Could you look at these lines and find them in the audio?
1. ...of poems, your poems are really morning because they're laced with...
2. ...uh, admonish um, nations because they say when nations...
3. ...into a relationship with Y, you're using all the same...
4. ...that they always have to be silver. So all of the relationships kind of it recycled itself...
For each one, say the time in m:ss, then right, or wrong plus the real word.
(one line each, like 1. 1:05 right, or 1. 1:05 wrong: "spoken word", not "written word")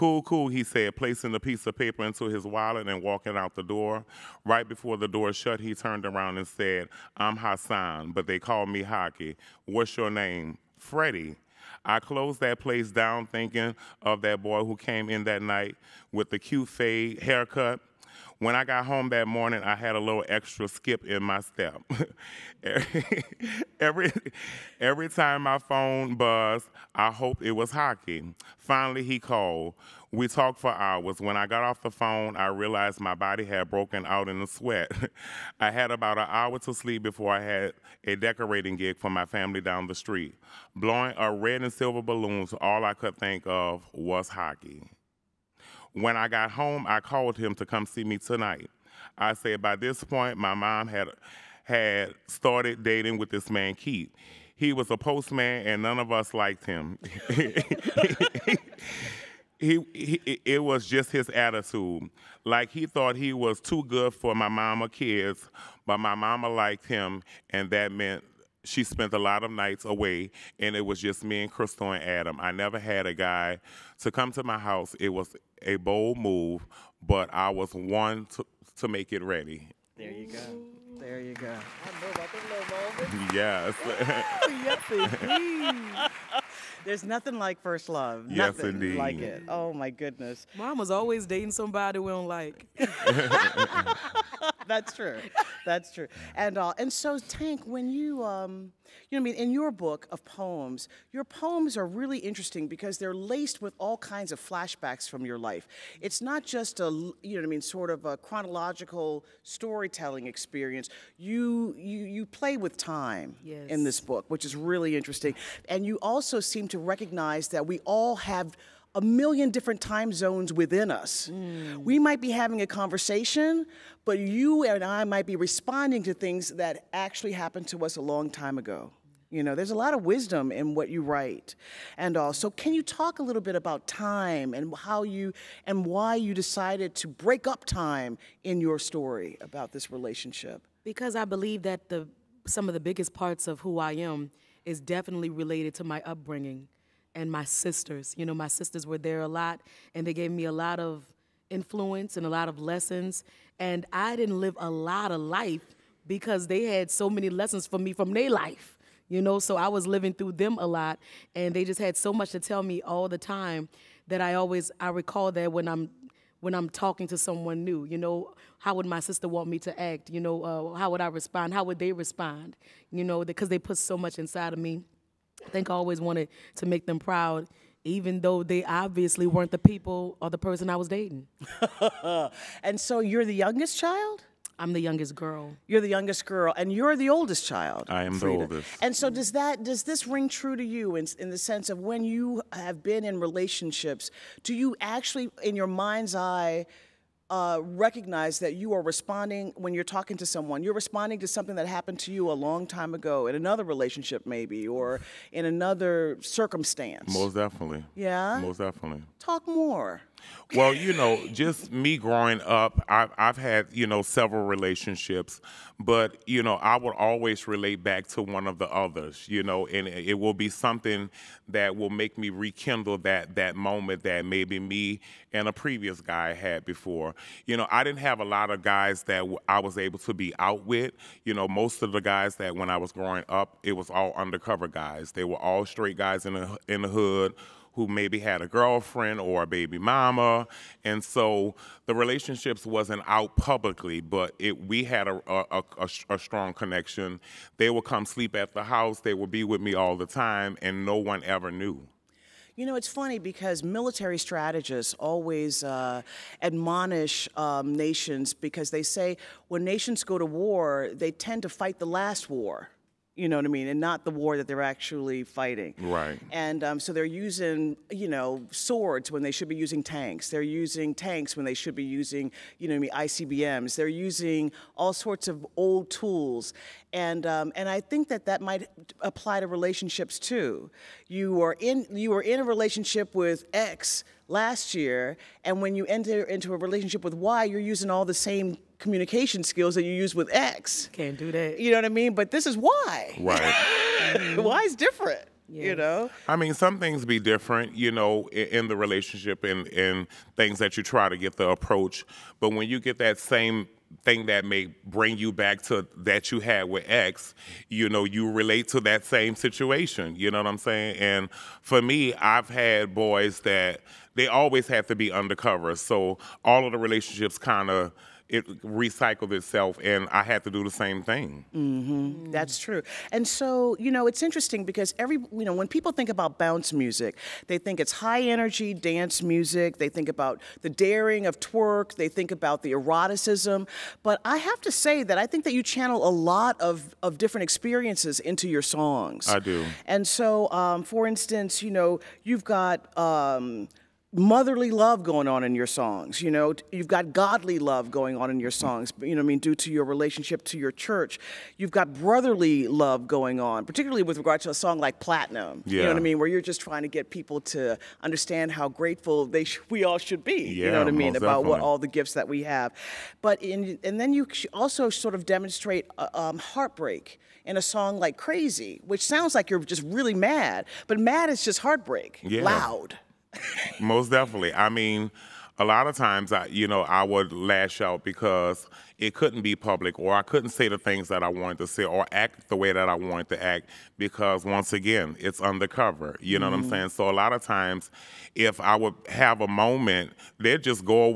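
1. 1:40 wrong: "interesting", not "morning"
2. 4:15 right
3. 4:46 right
4. 5:13 wrong: "undercover", not "silver".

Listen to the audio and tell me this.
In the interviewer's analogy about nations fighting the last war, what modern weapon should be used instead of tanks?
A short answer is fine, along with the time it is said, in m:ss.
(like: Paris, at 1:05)
ICBMs, at 4:32.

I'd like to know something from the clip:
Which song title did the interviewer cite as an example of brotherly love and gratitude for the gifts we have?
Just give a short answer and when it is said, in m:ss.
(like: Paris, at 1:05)
Platinum, at 5:54.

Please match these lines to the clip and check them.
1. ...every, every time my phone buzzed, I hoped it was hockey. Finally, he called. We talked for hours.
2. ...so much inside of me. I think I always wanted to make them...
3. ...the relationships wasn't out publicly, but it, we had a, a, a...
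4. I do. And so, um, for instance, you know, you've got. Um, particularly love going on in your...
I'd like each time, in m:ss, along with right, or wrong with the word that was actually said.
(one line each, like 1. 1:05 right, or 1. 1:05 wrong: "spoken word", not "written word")
1. 0:23 right
2. 2:53 right
3. 4:01 right
4. 5:39 wrong: "motherly", not "particularly".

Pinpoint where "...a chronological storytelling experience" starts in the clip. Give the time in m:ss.
1:48.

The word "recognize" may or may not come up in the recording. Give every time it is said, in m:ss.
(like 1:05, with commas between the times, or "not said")
1:56, 3:17.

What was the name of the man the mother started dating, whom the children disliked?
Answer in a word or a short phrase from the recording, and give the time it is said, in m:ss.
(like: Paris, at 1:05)
Keith, at 0:53.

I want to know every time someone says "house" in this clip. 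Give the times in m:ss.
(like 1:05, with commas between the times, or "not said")
1:14, 4:08.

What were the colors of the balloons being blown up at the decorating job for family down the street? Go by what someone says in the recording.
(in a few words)
red and silver.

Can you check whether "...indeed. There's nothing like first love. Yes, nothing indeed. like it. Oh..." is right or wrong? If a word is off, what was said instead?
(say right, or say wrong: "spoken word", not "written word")
right.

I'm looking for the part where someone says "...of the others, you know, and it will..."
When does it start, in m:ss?
3:38.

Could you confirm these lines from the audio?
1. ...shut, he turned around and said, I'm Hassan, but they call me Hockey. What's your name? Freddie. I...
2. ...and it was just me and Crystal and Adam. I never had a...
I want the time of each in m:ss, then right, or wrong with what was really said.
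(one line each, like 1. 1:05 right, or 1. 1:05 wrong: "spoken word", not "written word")
1. 0:05 right
2. 1:10 right.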